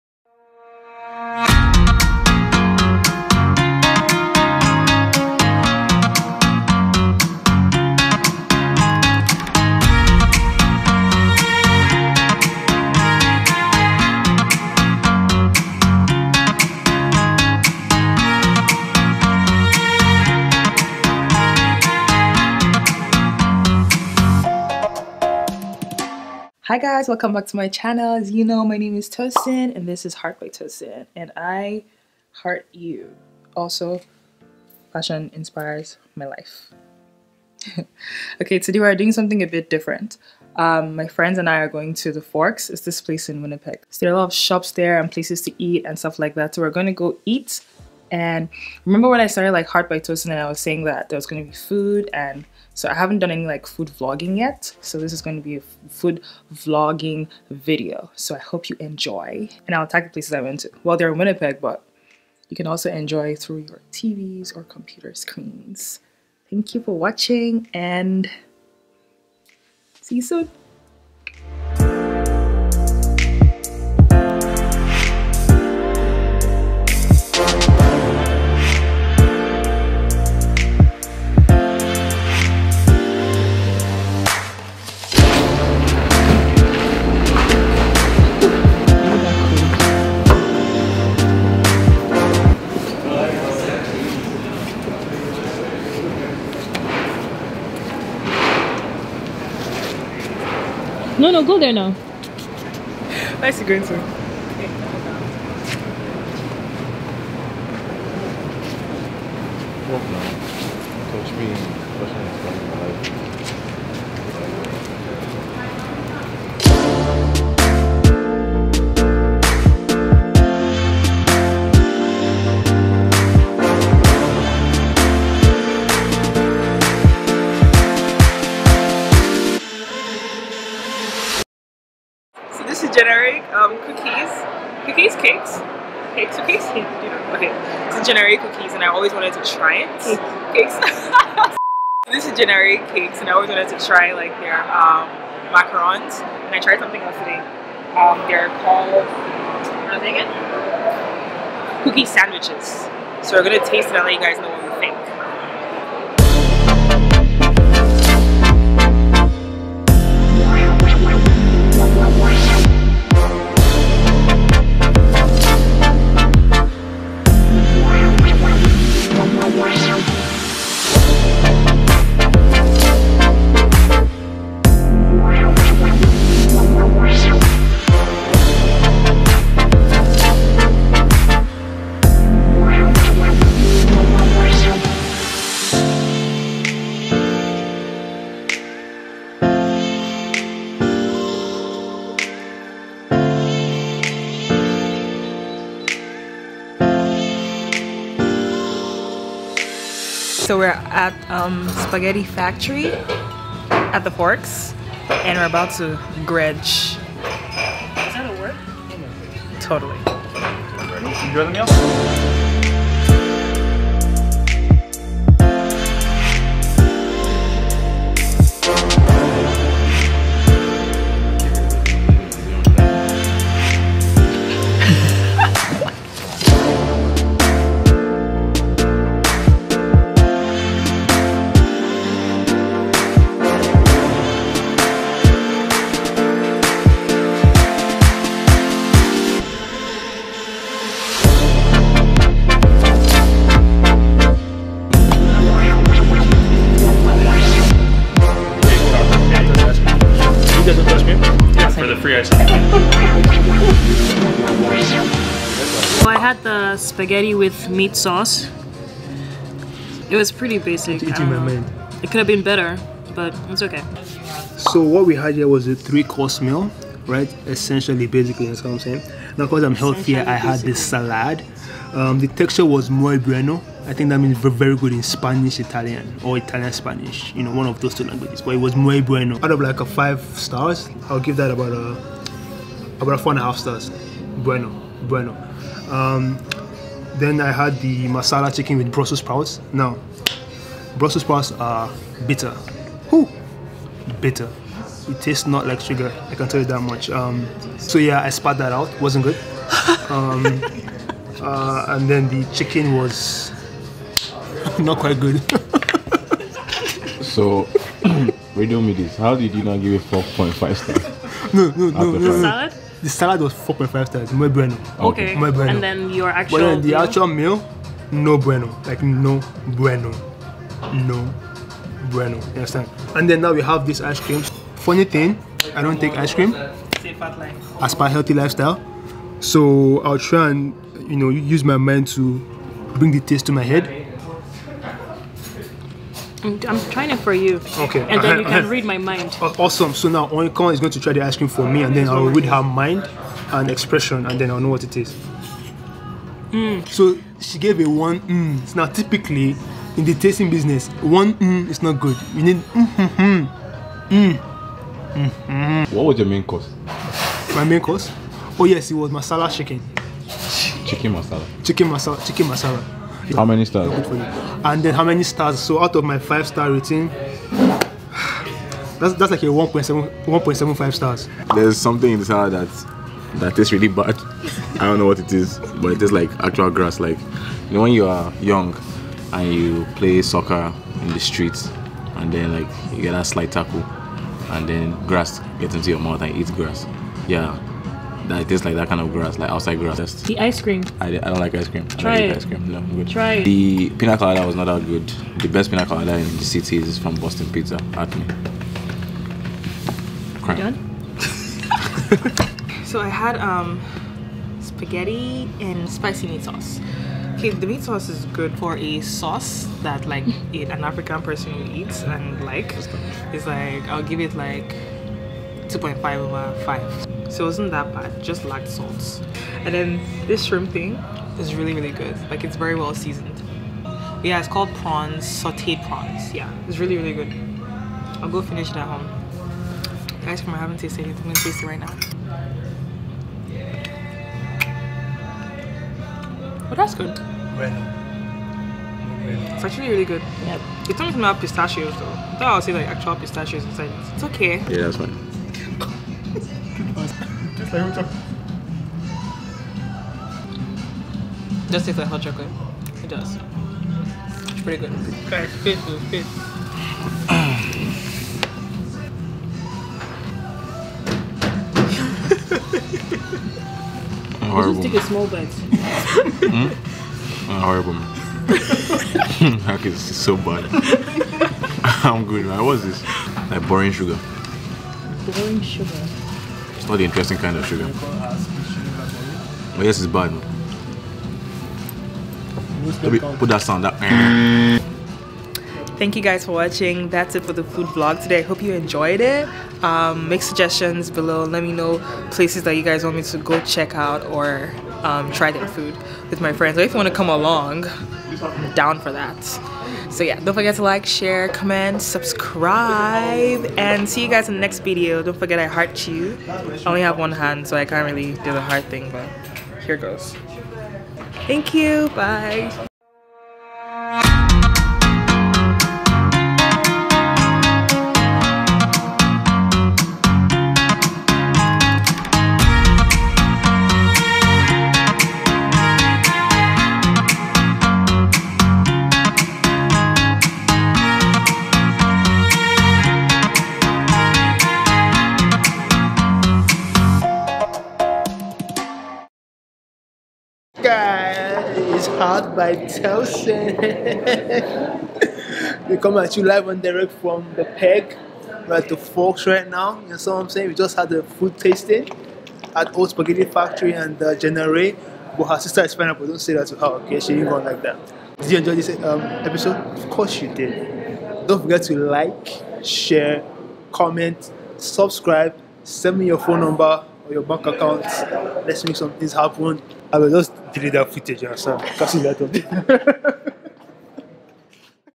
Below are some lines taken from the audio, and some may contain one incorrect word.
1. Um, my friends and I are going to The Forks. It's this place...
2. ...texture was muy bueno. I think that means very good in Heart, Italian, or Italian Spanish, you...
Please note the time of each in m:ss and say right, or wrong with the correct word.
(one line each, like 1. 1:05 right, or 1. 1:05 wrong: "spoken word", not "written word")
1. 0:40 right
2. 4:32 wrong: "Spanish", not "Heart".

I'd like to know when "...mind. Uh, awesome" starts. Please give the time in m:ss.
5:38.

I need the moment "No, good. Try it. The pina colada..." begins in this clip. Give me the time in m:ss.
6:32.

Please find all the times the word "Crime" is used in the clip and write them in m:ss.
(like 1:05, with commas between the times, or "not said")
6:40.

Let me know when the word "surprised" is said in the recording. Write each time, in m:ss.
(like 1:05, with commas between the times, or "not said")
not said.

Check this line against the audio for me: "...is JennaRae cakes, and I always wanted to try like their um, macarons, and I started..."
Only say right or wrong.
wrong.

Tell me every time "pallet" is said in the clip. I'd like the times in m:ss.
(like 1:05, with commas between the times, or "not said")
not said.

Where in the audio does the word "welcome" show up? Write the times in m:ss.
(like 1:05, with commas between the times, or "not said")
0:27.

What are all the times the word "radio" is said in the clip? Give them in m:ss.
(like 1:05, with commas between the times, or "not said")
5:08.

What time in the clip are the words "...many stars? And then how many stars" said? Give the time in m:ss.
6:03.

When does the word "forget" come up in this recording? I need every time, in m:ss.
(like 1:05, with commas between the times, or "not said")
8:20, 8:25, 9:21.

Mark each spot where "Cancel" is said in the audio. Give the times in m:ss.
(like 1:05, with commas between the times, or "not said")
9:31.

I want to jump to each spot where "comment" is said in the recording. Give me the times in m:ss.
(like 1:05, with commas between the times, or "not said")
8:21, 9:23.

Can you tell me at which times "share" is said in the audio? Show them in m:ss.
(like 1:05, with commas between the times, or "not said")
8:21, 9:22.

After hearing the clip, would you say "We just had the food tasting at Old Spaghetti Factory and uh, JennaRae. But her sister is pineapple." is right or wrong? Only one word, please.
right.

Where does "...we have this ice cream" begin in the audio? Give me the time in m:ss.
5:23.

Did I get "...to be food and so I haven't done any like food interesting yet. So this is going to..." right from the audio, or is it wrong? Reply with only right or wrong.
wrong.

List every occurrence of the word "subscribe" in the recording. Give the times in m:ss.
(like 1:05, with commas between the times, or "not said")
8:22, 9:24.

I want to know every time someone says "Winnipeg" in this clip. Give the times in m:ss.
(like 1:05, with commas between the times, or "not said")
0:43, 1:01.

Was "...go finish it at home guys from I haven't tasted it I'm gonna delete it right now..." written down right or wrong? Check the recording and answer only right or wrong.
wrong.